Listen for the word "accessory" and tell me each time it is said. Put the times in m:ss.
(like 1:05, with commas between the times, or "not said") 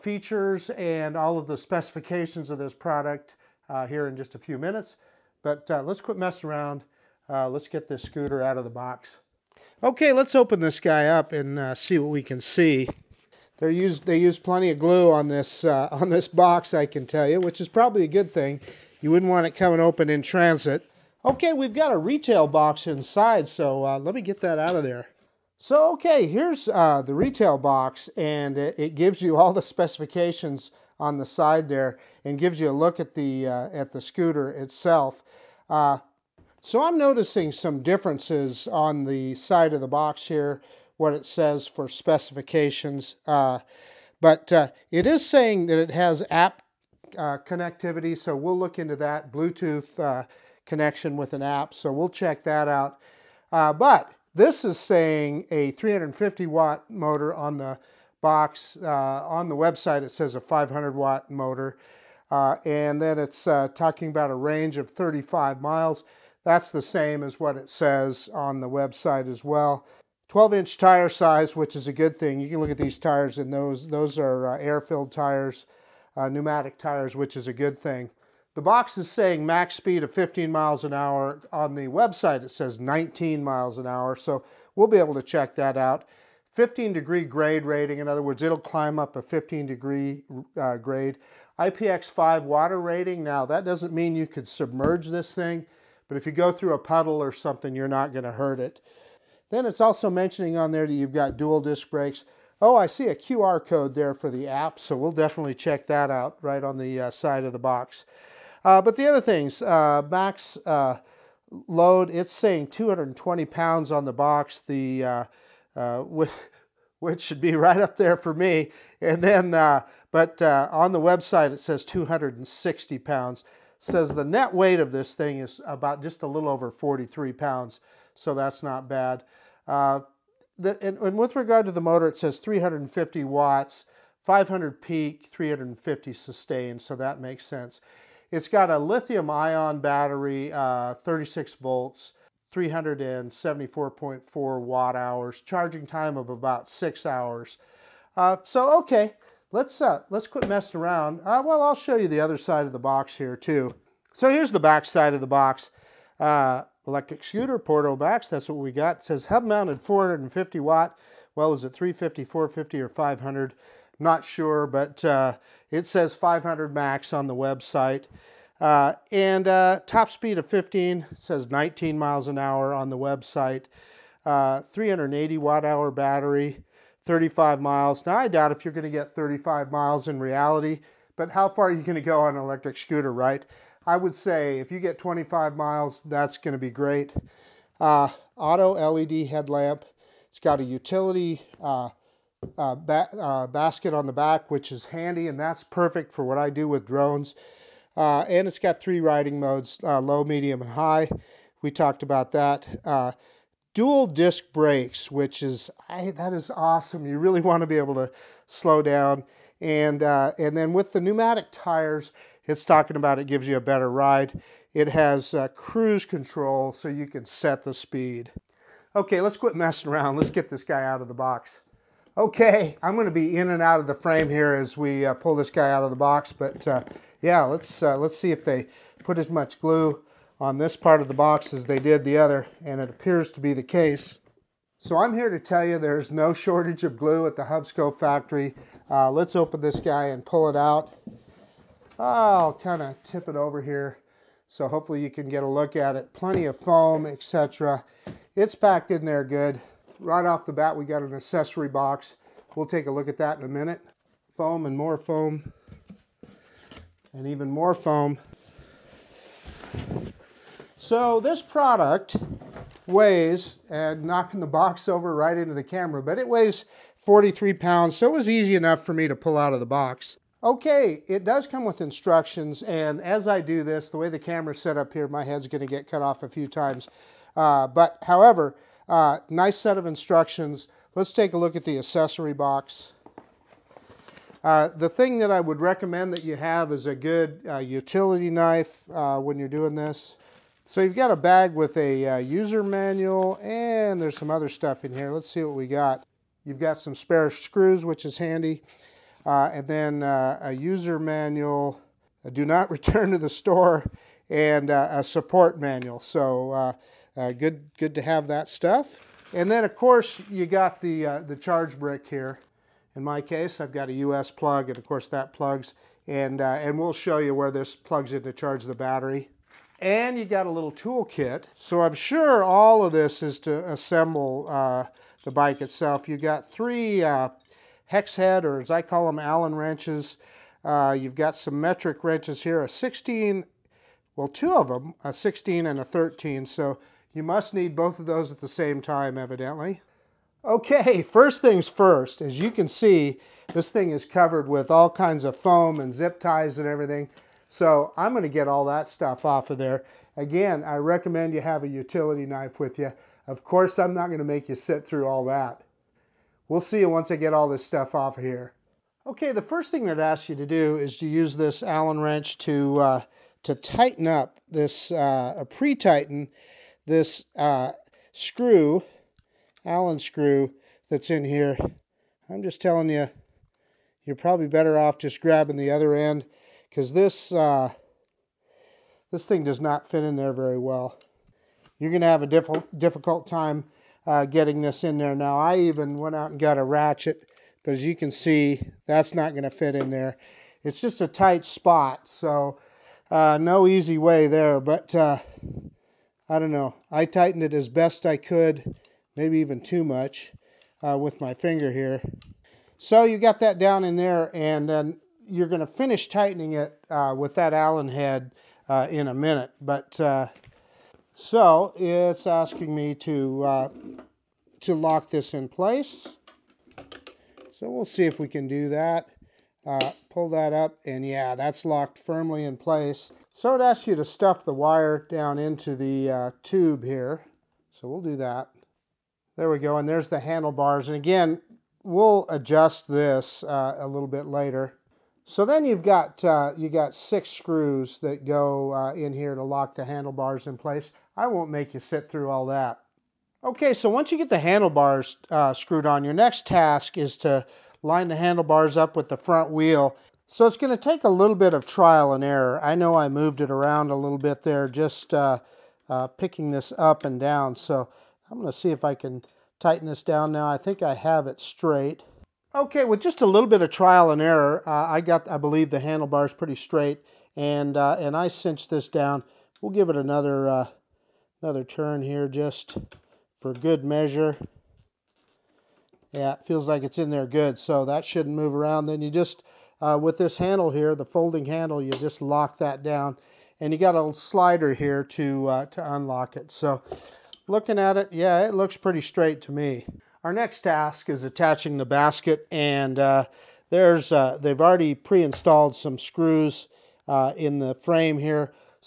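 4:11, 4:41.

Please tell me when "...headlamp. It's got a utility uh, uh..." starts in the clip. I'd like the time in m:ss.
3:09.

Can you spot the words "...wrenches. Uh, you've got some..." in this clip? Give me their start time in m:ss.
5:29.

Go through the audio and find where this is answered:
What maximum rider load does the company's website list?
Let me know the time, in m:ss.
2:01.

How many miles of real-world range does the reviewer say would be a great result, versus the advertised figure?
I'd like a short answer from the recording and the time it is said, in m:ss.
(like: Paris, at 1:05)
25 miles, at 3:04.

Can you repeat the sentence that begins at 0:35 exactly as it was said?
Uh, so I'm noticing some differences on the side of the box here what it says for specifications.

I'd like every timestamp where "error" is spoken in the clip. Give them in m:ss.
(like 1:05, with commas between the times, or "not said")
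7:32, 7:44.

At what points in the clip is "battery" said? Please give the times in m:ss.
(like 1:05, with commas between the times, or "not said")
2:19, 2:55, 5:18.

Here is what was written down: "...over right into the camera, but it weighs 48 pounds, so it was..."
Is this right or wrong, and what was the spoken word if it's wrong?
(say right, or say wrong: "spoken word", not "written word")
wrong: "43", not "48".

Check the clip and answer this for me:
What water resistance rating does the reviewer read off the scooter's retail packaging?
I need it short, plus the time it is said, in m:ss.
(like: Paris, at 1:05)
IPX5, at 1:31.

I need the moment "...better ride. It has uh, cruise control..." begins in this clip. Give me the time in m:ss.
3:33.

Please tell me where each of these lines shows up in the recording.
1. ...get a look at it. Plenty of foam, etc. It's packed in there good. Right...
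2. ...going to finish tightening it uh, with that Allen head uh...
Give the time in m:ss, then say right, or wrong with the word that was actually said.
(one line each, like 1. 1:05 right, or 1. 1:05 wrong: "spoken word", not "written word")
1. 4:05 right
2. 6:45 right.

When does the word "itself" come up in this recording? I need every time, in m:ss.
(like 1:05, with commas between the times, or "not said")
0:34, 5:25.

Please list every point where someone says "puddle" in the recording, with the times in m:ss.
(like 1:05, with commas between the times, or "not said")
1:36.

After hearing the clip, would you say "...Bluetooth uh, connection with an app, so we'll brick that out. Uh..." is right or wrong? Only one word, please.
wrong.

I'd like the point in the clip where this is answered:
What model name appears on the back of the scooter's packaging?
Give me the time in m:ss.
2:37.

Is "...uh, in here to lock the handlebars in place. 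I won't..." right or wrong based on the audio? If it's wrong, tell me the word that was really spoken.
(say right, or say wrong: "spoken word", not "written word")
right.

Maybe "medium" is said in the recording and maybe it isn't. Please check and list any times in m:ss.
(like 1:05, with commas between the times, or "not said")
3:20.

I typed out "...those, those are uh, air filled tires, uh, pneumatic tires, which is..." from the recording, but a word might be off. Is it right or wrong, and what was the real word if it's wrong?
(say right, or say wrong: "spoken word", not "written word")
right.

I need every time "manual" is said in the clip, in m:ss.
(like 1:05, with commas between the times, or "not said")
4:52, 5:00, 5:05.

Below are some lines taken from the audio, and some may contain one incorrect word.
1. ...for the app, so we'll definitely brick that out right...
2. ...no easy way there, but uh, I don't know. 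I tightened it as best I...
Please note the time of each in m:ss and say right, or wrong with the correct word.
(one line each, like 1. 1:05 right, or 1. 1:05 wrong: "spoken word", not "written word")
1. 1:44 wrong: "check", not "brick"
2. 6:33 right.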